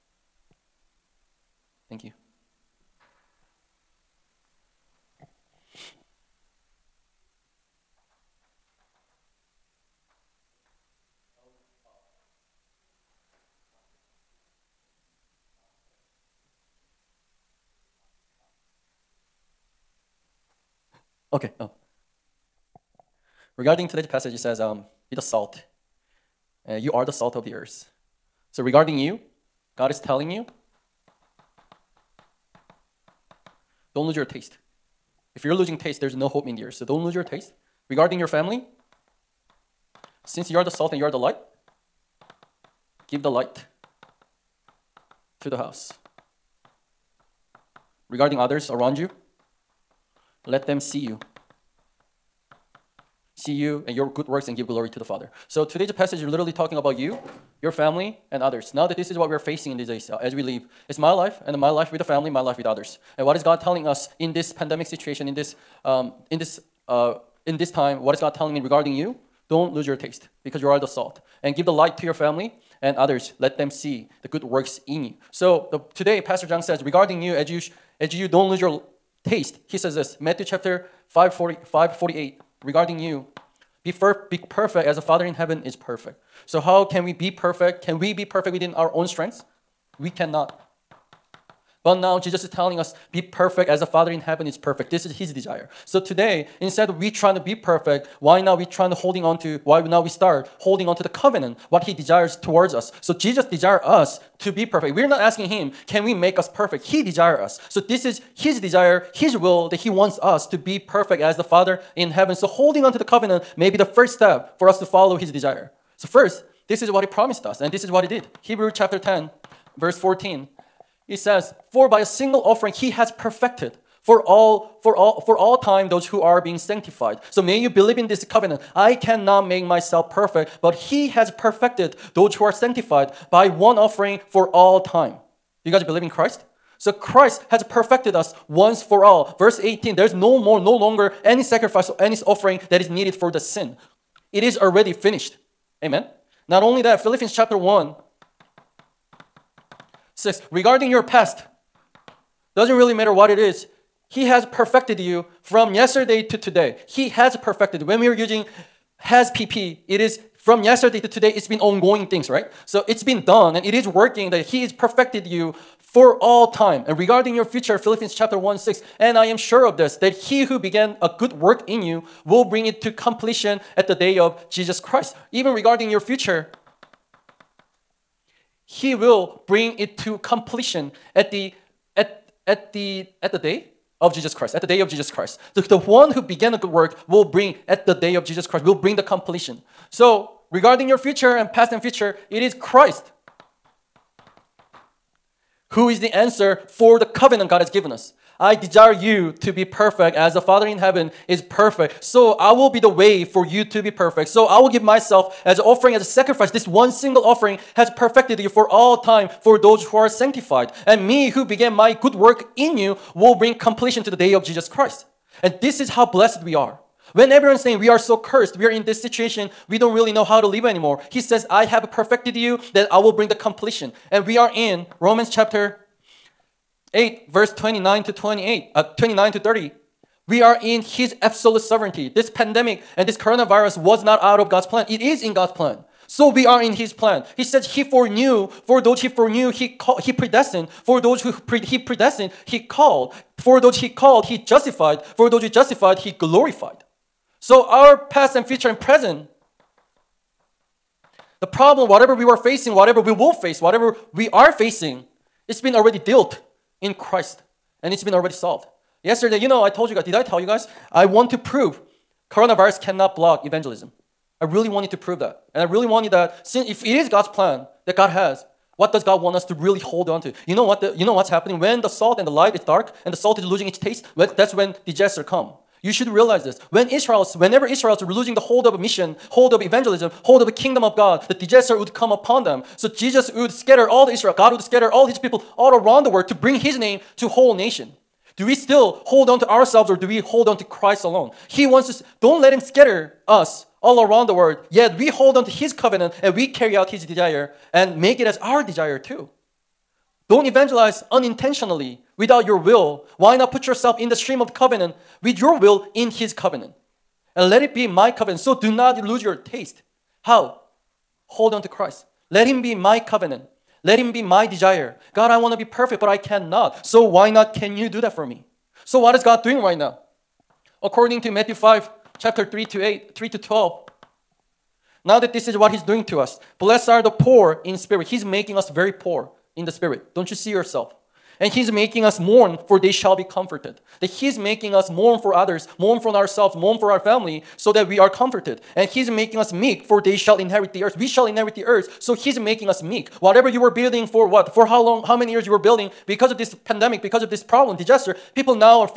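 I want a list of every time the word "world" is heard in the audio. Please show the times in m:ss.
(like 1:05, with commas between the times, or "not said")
4:46, 4:54.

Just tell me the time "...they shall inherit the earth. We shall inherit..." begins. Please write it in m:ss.
5:39.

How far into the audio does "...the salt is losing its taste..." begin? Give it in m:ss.
4:33.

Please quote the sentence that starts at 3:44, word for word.
And we are in Romans chapter 8, verse 29 to 28, uh, 29 to 30.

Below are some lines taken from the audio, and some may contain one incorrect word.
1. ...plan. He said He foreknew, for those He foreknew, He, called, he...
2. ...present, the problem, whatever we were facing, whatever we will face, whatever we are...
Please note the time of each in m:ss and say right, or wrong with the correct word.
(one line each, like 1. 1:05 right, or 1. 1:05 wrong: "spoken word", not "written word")
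1. 3:56 right
2. 4:08 right.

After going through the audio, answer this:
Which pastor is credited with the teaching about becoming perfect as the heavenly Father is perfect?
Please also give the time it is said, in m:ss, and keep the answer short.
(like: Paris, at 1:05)
Pastor Jung, at 1:16.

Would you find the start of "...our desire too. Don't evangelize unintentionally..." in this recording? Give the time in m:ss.
4:58.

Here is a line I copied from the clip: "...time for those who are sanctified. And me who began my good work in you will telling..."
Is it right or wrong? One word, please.
wrong.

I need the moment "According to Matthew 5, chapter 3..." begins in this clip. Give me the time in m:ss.
5:20.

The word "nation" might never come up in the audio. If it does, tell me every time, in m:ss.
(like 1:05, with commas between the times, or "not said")
4:47.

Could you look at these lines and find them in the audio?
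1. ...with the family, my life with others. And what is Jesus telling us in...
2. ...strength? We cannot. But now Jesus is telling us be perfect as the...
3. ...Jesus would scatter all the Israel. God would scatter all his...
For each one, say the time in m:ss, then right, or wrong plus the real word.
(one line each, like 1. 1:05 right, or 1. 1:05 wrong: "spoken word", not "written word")
1. 1:01 wrong: "God", not "Jesus"
2. 1:29 right
3. 4:42 right.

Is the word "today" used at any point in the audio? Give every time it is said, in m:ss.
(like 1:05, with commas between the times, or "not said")
0:23, 0:55, 1:15, 1:36, 2:36, 2:41.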